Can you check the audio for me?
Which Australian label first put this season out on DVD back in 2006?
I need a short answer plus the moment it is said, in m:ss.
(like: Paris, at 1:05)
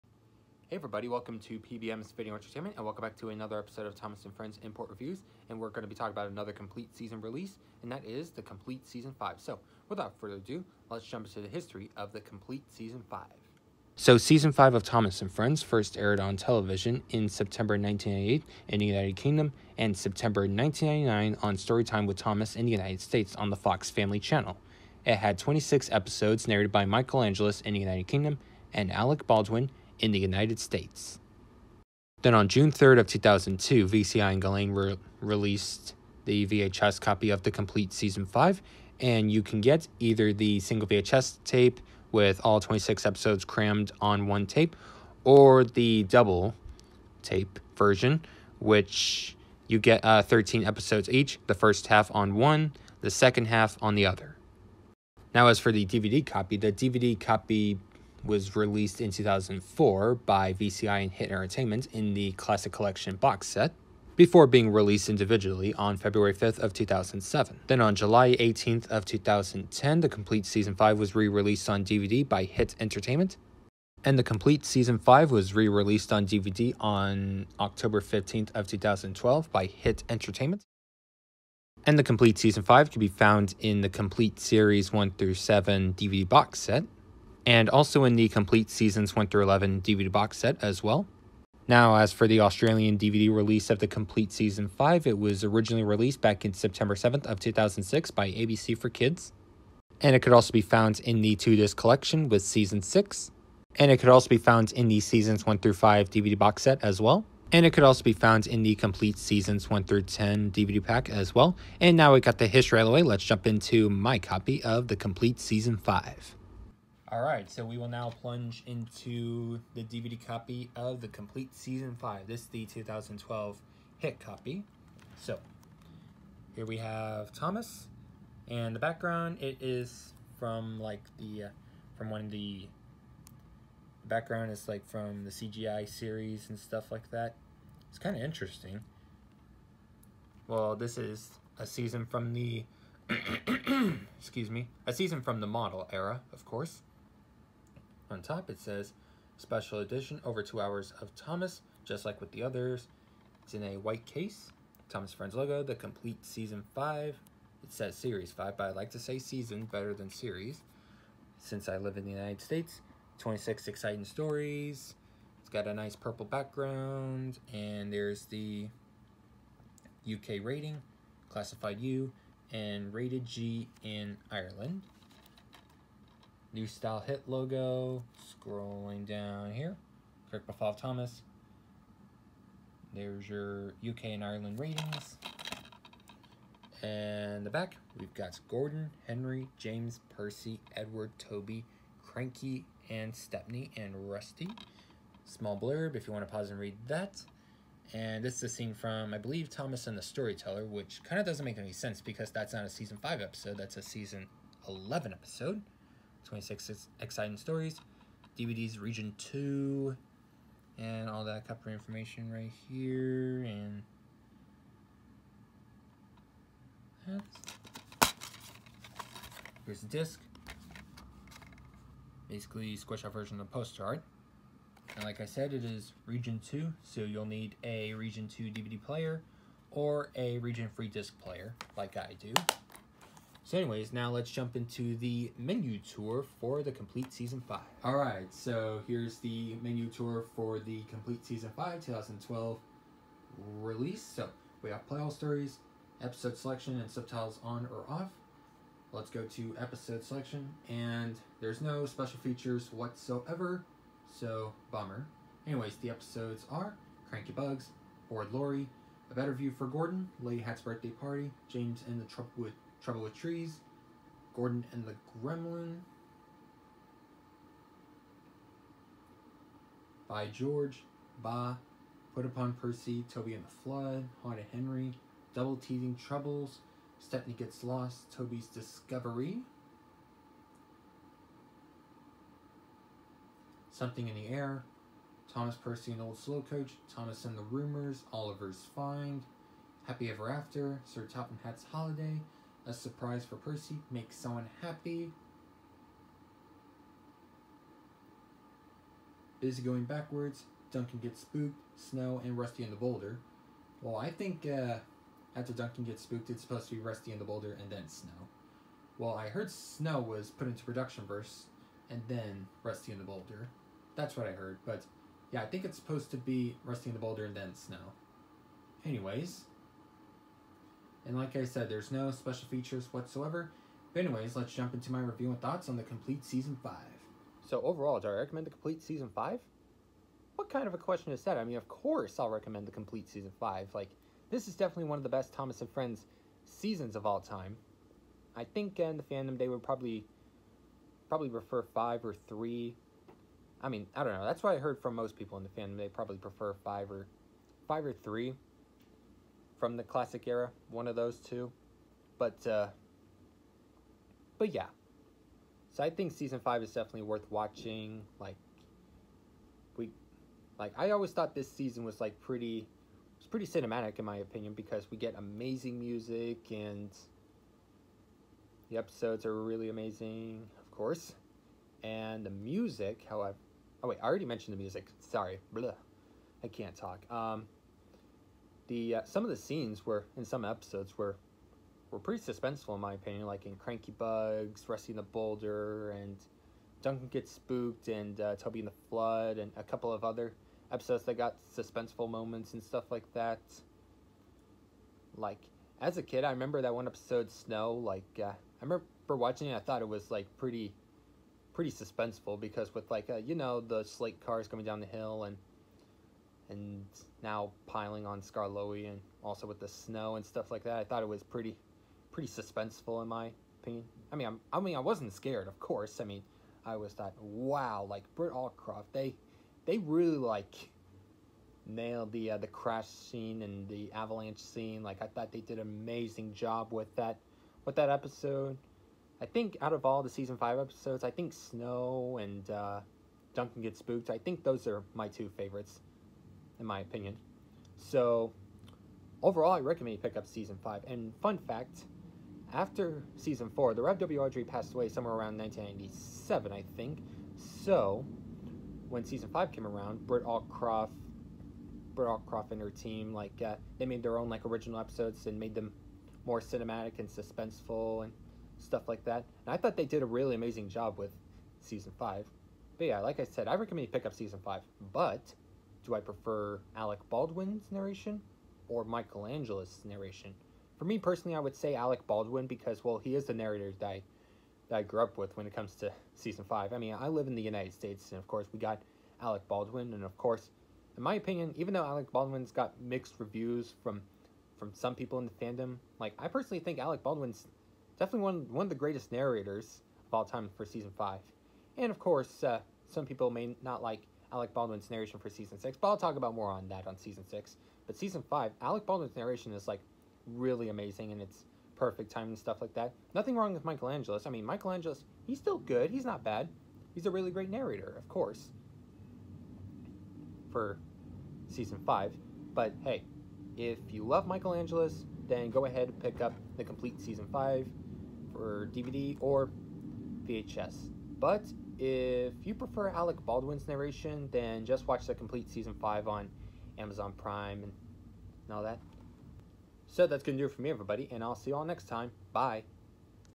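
ABC for Kids, at 1:38.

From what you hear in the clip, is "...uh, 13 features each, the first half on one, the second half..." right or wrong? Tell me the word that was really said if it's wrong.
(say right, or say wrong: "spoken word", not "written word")
wrong: "episodes", not "features".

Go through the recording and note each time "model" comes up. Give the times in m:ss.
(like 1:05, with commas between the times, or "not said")
2:25.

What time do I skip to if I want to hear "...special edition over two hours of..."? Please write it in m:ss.
2:29.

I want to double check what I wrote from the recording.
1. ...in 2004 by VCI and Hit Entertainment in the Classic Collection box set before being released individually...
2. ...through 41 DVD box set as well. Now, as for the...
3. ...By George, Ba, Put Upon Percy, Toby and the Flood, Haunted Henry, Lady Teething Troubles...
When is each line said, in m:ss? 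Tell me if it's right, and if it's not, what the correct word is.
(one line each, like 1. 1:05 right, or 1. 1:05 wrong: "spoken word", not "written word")
1. 0:59 right
2. 1:29 wrong: "11", not "41"
3. 4:30 wrong: "Double", not "Lady".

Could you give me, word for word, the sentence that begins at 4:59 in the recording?
Busy going backwards, Duncan gets spooked, Snow, and Rusty in the boulder.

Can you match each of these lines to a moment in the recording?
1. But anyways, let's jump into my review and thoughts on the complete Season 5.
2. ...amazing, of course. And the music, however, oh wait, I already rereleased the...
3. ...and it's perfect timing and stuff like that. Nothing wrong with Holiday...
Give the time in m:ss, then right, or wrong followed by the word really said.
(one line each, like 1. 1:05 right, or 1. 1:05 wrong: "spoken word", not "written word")
1. 5:23 right
2. 6:09 wrong: "mentioned", not "rereleased"
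3. 8:21 wrong: "Michael", not "Holiday".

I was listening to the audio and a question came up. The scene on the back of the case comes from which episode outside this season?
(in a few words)
Thomas and the Storyteller.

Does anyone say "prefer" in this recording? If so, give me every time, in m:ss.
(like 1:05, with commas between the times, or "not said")
5:41, 5:46, 7:45, 8:42.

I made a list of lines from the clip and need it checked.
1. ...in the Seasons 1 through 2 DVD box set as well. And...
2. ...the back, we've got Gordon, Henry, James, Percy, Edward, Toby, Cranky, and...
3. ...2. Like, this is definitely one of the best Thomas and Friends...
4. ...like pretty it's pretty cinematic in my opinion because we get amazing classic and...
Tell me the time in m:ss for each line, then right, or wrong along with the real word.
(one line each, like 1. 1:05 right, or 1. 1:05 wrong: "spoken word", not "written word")
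1. 1:44 wrong: "5", not "2"
2. 3:07 right
3. 5:33 wrong: "5", not "2"
4. 6:02 wrong: "music", not "classic".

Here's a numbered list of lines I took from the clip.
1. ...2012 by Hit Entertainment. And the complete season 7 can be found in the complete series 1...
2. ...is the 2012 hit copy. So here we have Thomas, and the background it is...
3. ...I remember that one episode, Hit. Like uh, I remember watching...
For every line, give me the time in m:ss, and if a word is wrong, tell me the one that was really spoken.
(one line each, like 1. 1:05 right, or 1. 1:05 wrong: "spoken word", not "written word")
1. 1:18 wrong: "5", not "7"
2. 2:02 right
3. 6:36 wrong: "Snow", not "Hit".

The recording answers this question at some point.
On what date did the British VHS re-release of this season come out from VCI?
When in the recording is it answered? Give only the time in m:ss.
0:32.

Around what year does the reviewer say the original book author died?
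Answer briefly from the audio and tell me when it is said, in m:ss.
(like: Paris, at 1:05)
1997, at 7:25.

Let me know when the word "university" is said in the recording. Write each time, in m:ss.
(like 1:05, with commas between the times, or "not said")
not said.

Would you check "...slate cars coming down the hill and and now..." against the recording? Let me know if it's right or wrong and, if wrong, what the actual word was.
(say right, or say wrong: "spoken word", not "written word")
right.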